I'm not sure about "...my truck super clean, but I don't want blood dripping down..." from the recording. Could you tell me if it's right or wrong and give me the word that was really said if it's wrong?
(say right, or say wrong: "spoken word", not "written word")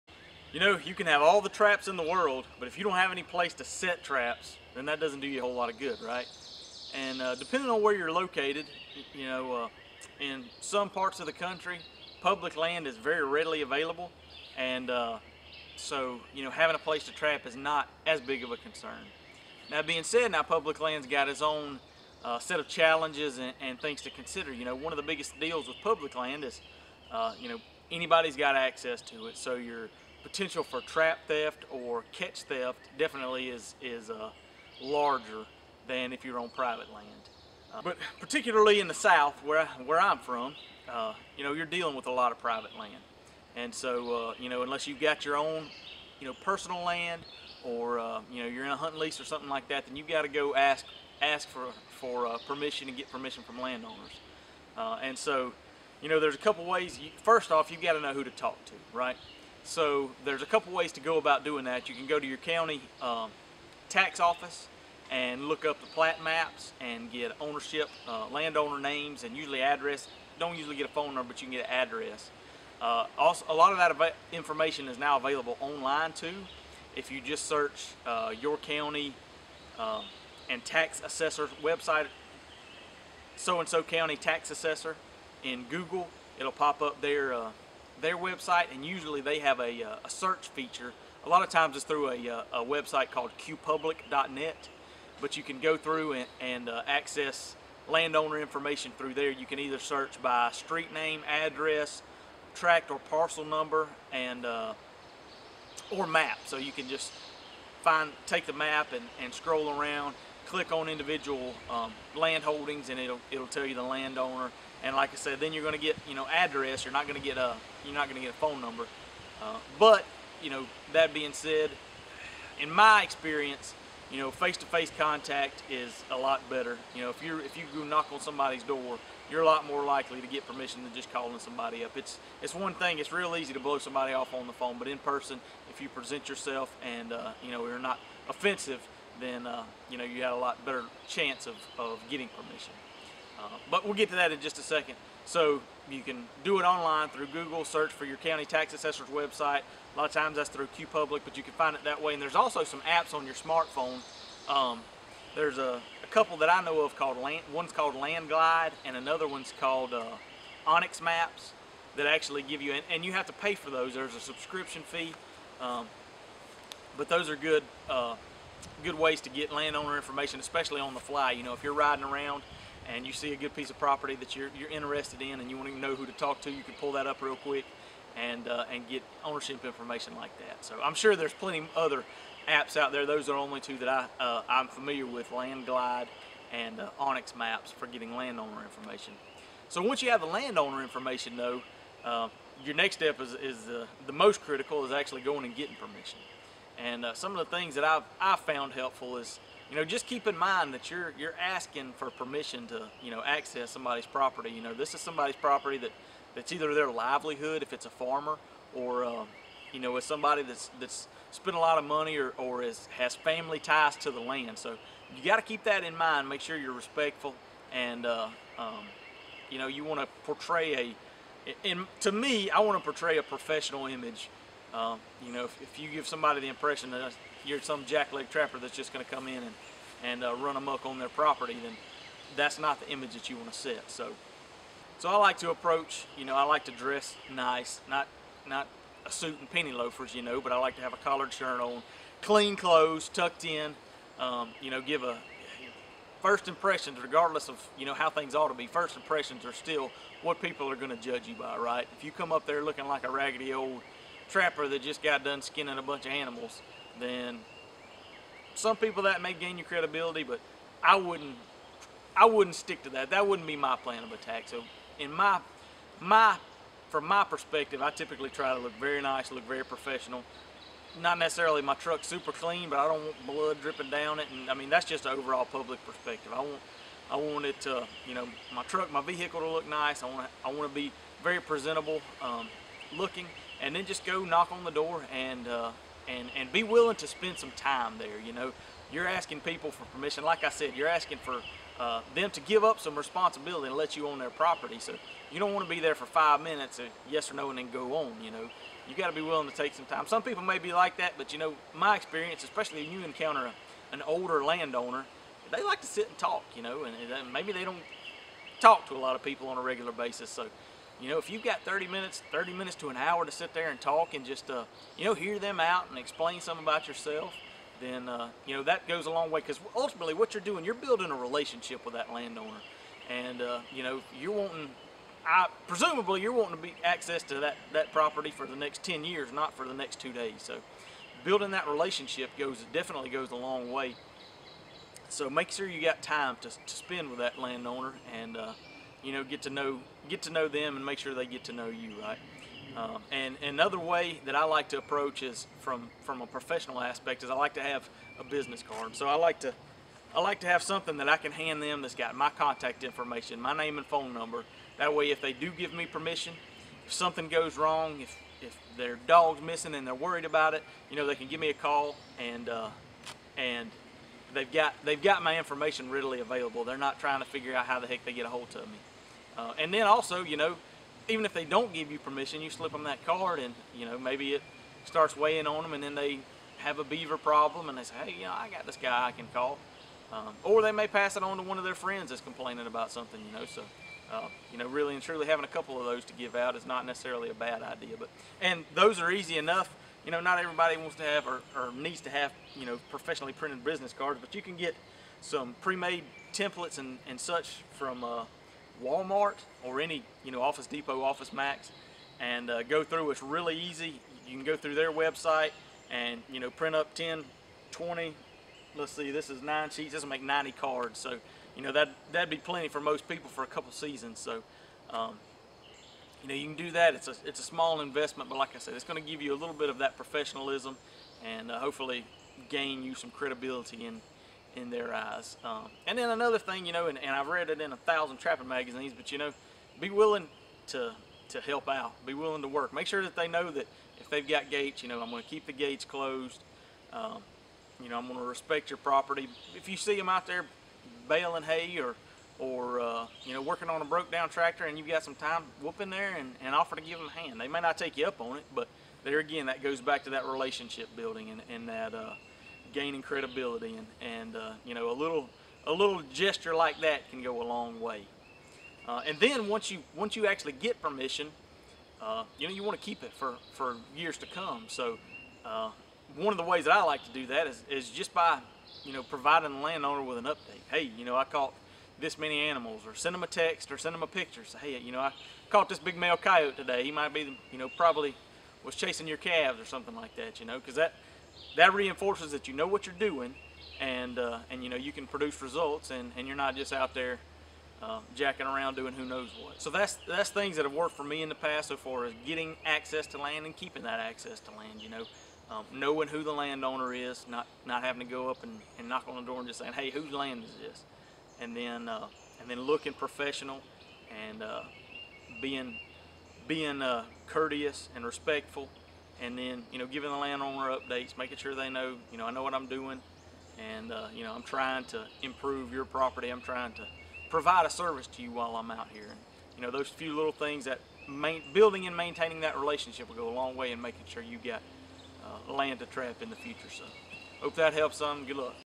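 right.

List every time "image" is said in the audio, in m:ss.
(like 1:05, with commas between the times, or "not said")
3:43, 3:52.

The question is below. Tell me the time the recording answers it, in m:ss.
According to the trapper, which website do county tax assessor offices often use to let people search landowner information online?
1:33.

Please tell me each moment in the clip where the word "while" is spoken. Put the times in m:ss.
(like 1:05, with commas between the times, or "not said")
8:38.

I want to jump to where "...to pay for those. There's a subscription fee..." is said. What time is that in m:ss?
2:43.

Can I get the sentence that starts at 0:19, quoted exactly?
Now, being said, now public land's got its own uh, set of challenges and, and, things to consider.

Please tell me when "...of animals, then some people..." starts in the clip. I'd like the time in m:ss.
4:16.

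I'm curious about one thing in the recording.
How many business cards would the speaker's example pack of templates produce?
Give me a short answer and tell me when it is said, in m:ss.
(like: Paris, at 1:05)
90, at 6:50.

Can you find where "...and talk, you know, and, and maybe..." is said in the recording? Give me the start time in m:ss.
5:06.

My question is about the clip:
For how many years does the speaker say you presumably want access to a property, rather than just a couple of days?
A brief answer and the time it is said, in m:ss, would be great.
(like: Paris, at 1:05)
10, at 5:28.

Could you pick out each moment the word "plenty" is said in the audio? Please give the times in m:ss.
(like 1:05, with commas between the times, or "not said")
3:01, 6:52.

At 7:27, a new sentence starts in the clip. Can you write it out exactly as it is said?
They may not take you up on it, but there again, that goes back to that relationship building and, and that.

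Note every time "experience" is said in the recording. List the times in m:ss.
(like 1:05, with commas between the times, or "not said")
2:03, 5:01.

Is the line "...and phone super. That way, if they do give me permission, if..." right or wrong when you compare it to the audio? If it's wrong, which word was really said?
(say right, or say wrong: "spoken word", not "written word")
wrong: "number", not "super".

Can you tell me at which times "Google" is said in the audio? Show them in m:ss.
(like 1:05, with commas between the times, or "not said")
1:25, 2:27.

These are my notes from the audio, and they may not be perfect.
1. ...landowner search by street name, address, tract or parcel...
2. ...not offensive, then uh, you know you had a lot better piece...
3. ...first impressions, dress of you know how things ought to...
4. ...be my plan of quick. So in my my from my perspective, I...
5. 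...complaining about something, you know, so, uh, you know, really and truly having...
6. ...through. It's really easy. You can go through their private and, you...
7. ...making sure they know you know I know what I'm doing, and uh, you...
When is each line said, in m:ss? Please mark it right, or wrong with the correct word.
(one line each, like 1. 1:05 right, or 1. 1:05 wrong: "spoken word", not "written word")
1. 1:39 wrong: "either", not "landowner"
2. 2:17 wrong: "chance", not "piece"
3. 4:06 wrong: "regardless", not "dress"
4. 4:23 wrong: "attack", not "quick"
5. 6:22 right
6. 6:42 wrong: "website", not "private"
7. 8:31 right.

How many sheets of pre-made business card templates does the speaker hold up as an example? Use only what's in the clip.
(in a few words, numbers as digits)
9.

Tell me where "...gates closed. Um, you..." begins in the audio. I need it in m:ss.
7:15.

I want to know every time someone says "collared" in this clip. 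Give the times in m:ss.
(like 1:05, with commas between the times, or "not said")
4:00.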